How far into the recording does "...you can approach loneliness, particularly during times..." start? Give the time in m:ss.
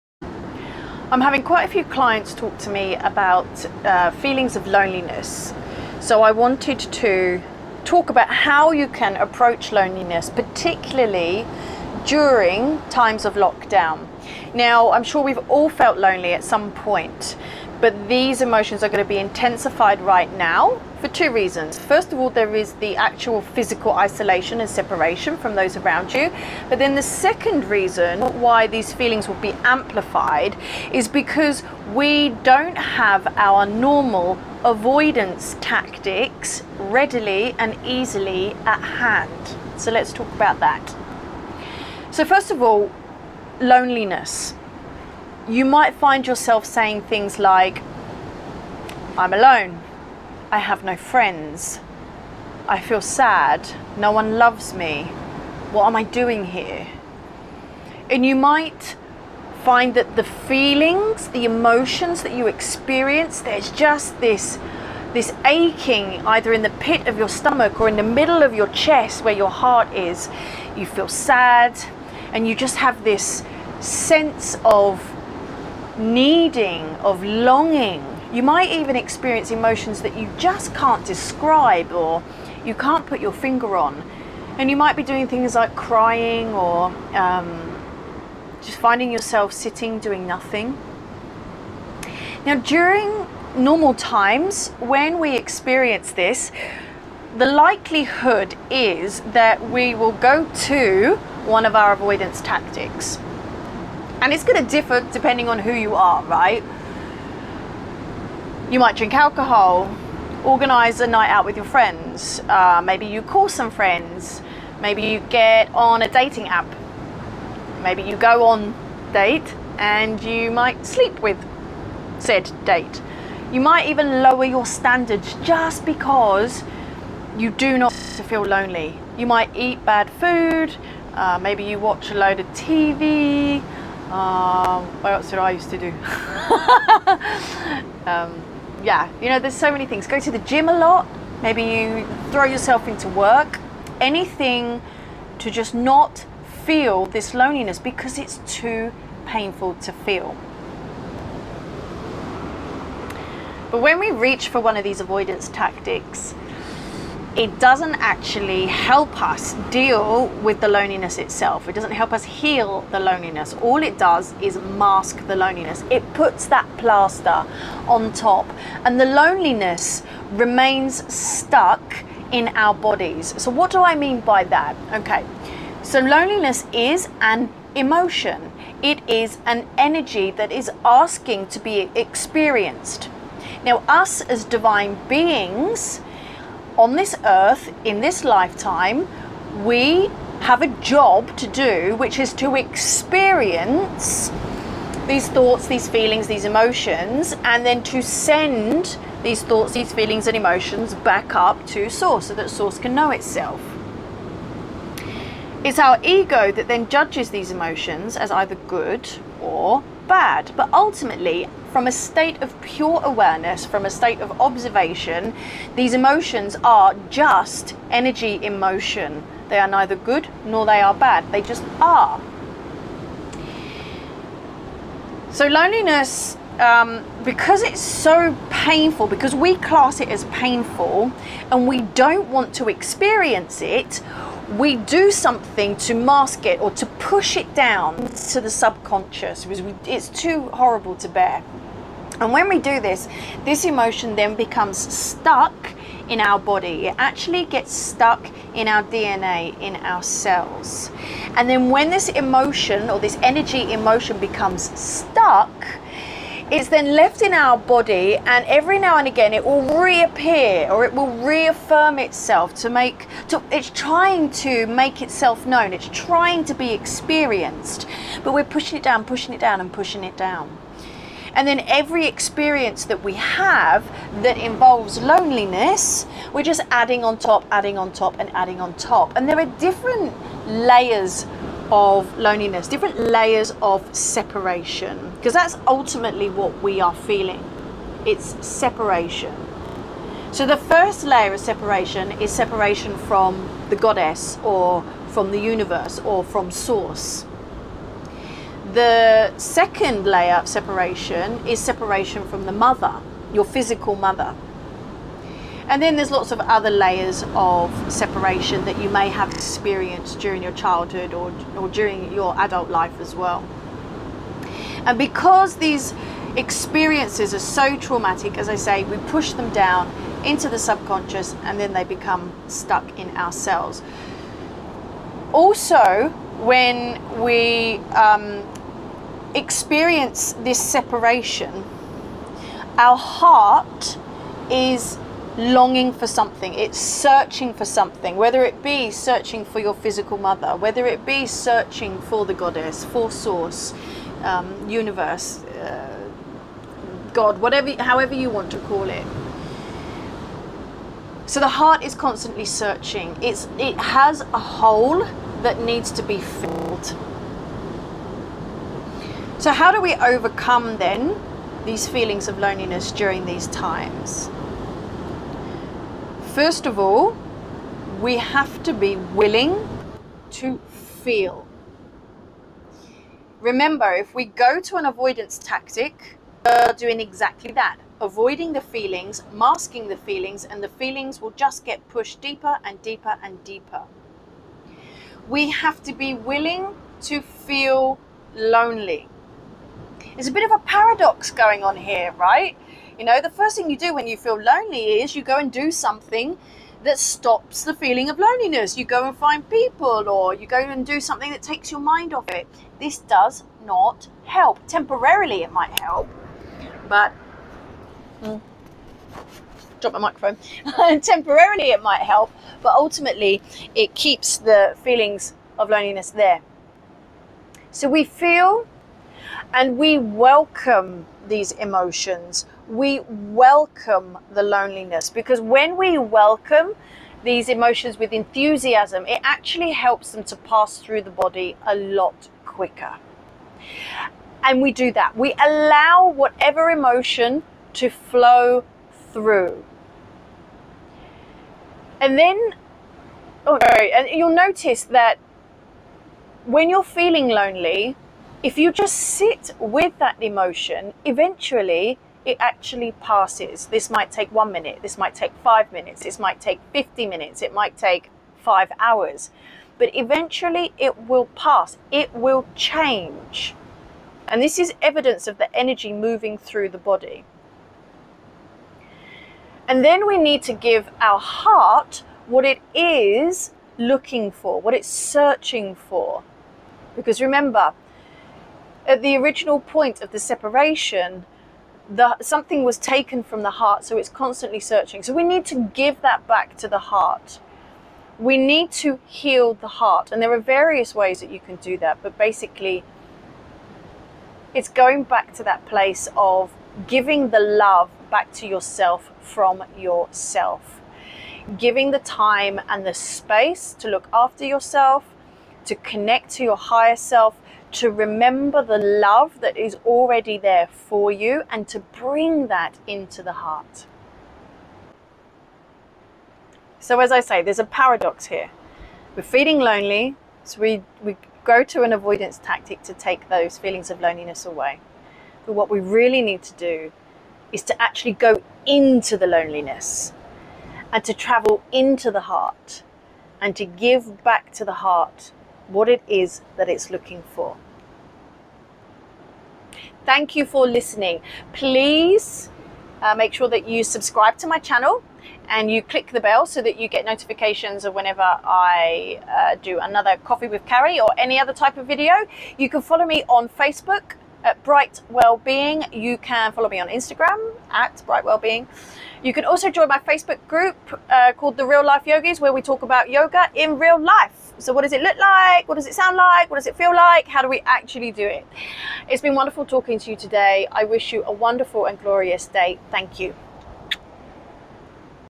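0:08.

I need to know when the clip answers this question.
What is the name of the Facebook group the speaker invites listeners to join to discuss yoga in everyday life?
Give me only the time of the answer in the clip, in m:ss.
9:21.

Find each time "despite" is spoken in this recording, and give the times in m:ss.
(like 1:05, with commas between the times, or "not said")
not said.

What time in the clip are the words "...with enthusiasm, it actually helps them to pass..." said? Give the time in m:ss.
7:07.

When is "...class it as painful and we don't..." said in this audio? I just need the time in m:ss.
3:49.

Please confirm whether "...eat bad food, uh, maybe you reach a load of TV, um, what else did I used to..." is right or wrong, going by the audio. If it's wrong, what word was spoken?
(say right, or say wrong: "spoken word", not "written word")
wrong: "watch", not "reach".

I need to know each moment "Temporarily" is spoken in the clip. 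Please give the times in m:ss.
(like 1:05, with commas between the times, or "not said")
6:44, 6:51.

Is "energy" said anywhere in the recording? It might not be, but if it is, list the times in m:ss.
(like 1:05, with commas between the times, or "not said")
2:59, 3:37, 4:13, 7:45.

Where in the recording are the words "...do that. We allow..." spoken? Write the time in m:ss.
7:14.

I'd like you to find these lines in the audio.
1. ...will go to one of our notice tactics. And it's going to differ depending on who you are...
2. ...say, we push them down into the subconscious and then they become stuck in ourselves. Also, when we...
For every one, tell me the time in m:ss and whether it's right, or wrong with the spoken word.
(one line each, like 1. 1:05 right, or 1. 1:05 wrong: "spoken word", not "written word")
1. 1:39 wrong: "avoidance", not "notice"
2. 5:18 right.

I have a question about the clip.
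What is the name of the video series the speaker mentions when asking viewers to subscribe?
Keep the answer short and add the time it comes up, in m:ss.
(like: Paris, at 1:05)
Coffee with Carrie, at 9:10.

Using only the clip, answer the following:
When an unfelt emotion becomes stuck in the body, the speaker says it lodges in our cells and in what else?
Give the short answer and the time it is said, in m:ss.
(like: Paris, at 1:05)
DNA, at 4:08.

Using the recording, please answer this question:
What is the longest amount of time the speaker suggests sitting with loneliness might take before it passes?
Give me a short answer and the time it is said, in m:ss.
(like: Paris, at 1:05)
5 hours, at 7:38.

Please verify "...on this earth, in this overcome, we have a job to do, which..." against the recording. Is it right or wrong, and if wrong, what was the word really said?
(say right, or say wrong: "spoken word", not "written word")
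wrong: "lifetime", not "overcome".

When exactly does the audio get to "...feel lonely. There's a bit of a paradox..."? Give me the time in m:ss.
6:27.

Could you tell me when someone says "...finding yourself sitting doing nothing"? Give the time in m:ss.
1:28.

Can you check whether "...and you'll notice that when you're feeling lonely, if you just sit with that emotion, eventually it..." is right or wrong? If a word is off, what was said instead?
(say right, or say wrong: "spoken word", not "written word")
right.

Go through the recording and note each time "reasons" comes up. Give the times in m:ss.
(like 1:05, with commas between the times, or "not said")
0:21, 0:27.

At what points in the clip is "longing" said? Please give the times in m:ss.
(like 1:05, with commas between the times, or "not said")
1:17, 5:35.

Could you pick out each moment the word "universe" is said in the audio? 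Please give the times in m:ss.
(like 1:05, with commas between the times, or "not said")
4:55, 5:44.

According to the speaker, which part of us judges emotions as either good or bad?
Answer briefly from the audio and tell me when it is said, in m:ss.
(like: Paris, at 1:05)
ego, at 3:26.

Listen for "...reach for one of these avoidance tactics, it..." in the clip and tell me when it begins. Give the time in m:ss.
2:34.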